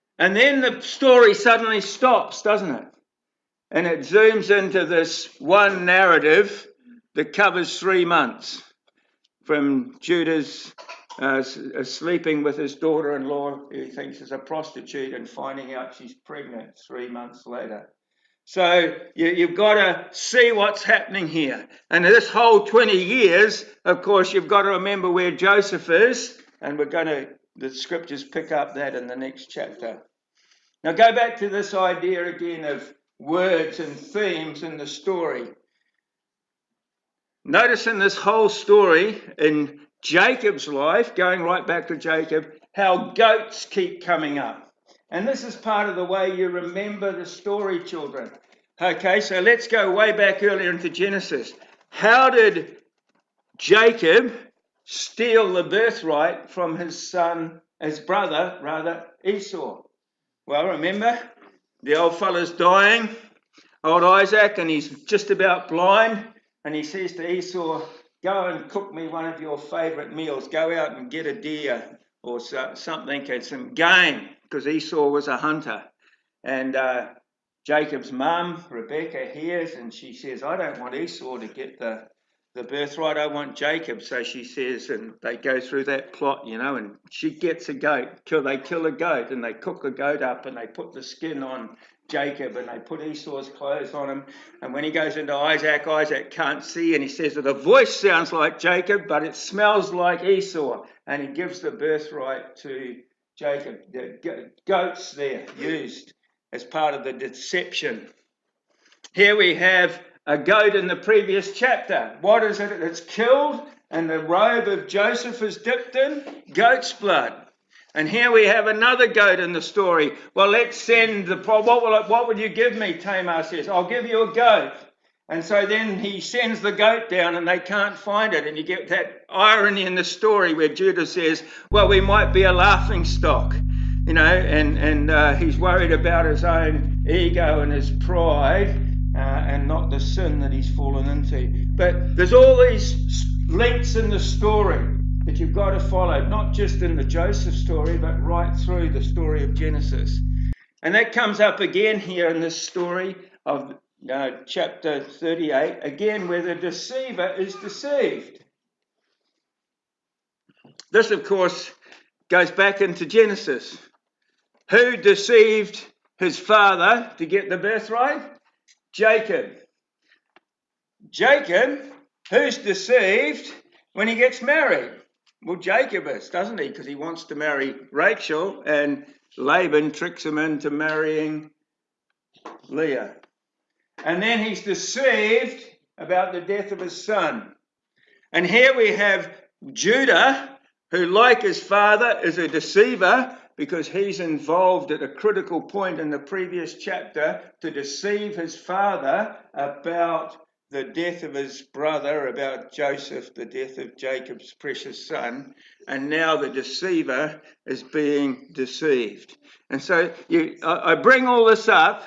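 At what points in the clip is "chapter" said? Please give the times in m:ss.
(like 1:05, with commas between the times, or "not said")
0:29, 1:51, 2:34, 3:16.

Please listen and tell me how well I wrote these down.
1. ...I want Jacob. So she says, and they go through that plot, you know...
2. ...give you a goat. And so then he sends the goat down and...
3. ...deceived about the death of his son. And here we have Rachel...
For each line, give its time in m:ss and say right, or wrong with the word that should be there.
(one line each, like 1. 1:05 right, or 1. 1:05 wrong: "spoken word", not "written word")
1. 1:23 right
2. 2:03 right
3. 3:04 wrong: "Judah", not "Rachel".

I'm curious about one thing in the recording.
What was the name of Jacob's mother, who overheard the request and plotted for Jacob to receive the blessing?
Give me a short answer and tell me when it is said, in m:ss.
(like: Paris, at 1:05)
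Rebecca, at 1:18.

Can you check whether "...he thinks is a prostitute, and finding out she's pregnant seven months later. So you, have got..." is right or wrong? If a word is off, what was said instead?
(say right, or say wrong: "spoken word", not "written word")
wrong: "three", not "seven".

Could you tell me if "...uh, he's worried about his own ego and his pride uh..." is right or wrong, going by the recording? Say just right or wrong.
right.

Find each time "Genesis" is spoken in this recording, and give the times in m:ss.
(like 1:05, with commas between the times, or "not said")
0:50, 2:29, 2:43.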